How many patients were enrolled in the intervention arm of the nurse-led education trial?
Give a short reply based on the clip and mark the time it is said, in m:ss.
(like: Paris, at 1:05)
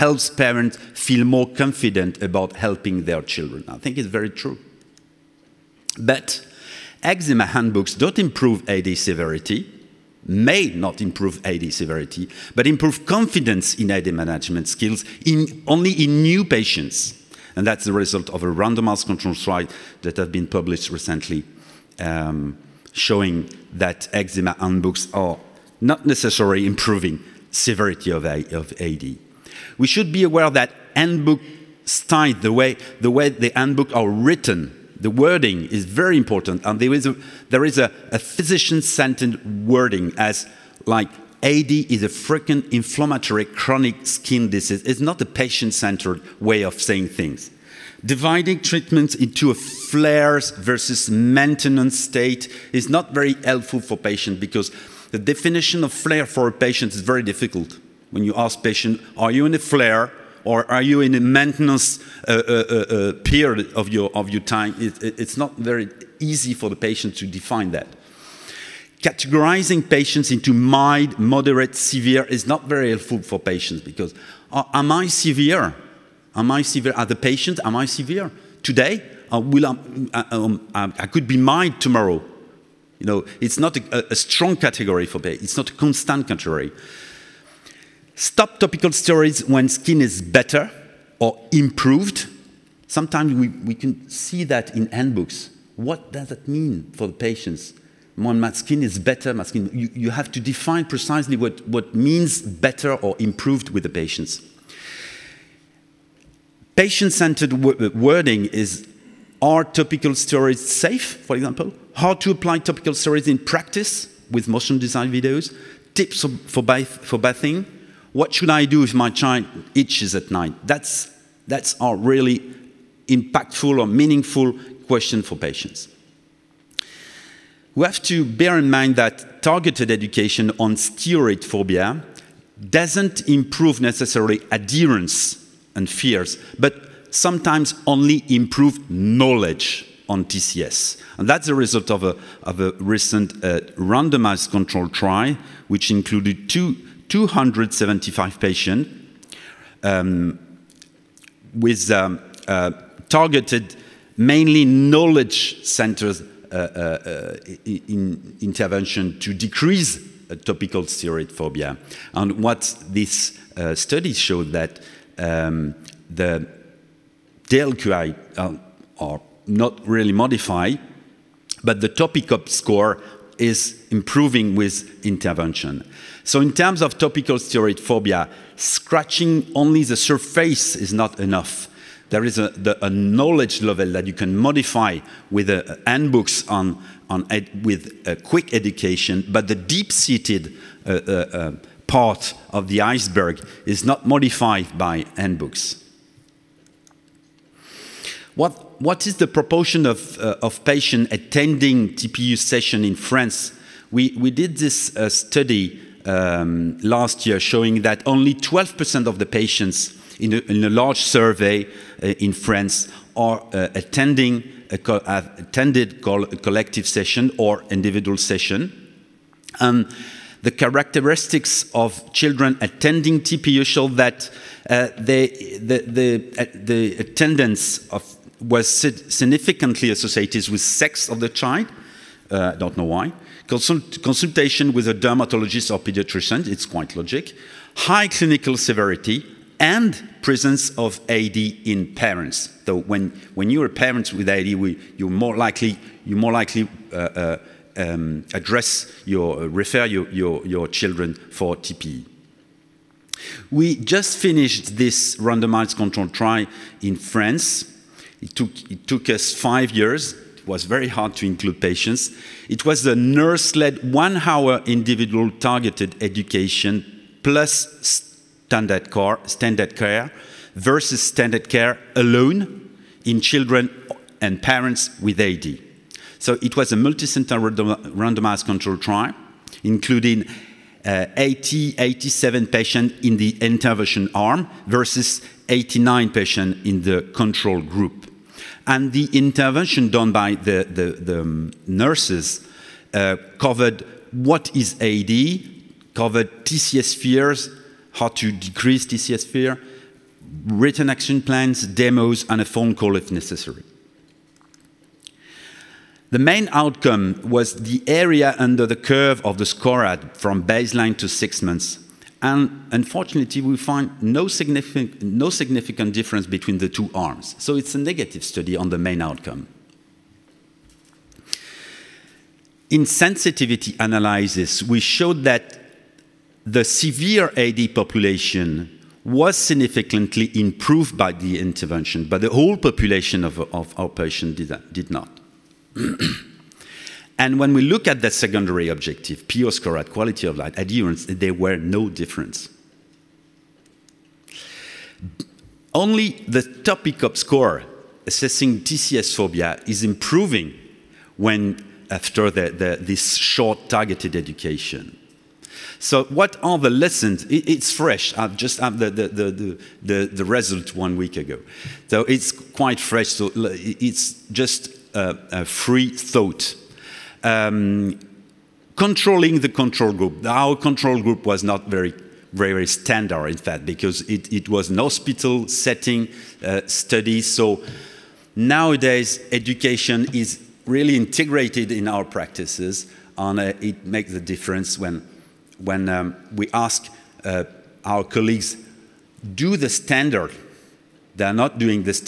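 87, at 4:41.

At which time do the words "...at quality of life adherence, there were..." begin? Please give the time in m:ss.
5:39.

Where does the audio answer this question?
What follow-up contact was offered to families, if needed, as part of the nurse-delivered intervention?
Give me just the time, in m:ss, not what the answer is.
5:02.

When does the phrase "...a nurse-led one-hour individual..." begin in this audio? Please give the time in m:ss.
4:22.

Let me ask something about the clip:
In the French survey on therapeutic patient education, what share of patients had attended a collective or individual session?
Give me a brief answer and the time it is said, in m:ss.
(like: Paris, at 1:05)
12%, at 3:28.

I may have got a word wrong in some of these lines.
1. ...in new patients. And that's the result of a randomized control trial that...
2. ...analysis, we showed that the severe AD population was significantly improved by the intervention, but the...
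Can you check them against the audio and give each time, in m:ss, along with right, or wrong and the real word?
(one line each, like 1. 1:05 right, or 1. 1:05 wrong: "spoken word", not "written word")
1. 0:15 right
2. 5:23 right.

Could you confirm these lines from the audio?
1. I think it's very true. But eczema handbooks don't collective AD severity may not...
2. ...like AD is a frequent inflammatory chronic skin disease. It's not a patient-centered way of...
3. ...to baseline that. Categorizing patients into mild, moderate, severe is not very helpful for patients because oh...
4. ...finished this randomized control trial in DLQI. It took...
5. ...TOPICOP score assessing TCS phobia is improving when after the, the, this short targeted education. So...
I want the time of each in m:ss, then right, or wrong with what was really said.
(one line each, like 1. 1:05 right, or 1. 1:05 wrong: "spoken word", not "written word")
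1. 0:03 wrong: "improve", not "collective"
2. 0:40 right
3. 1:07 wrong: "define", not "baseline"
4. 4:14 wrong: "France", not "DLQI"
5. 5:46 right.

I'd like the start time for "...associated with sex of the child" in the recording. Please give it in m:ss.
3:49.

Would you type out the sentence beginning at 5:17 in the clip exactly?
So it's a negative study on the main outcome.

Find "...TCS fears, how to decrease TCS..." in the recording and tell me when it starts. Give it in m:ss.
4:56.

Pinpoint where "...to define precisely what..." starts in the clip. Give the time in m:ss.
1:40.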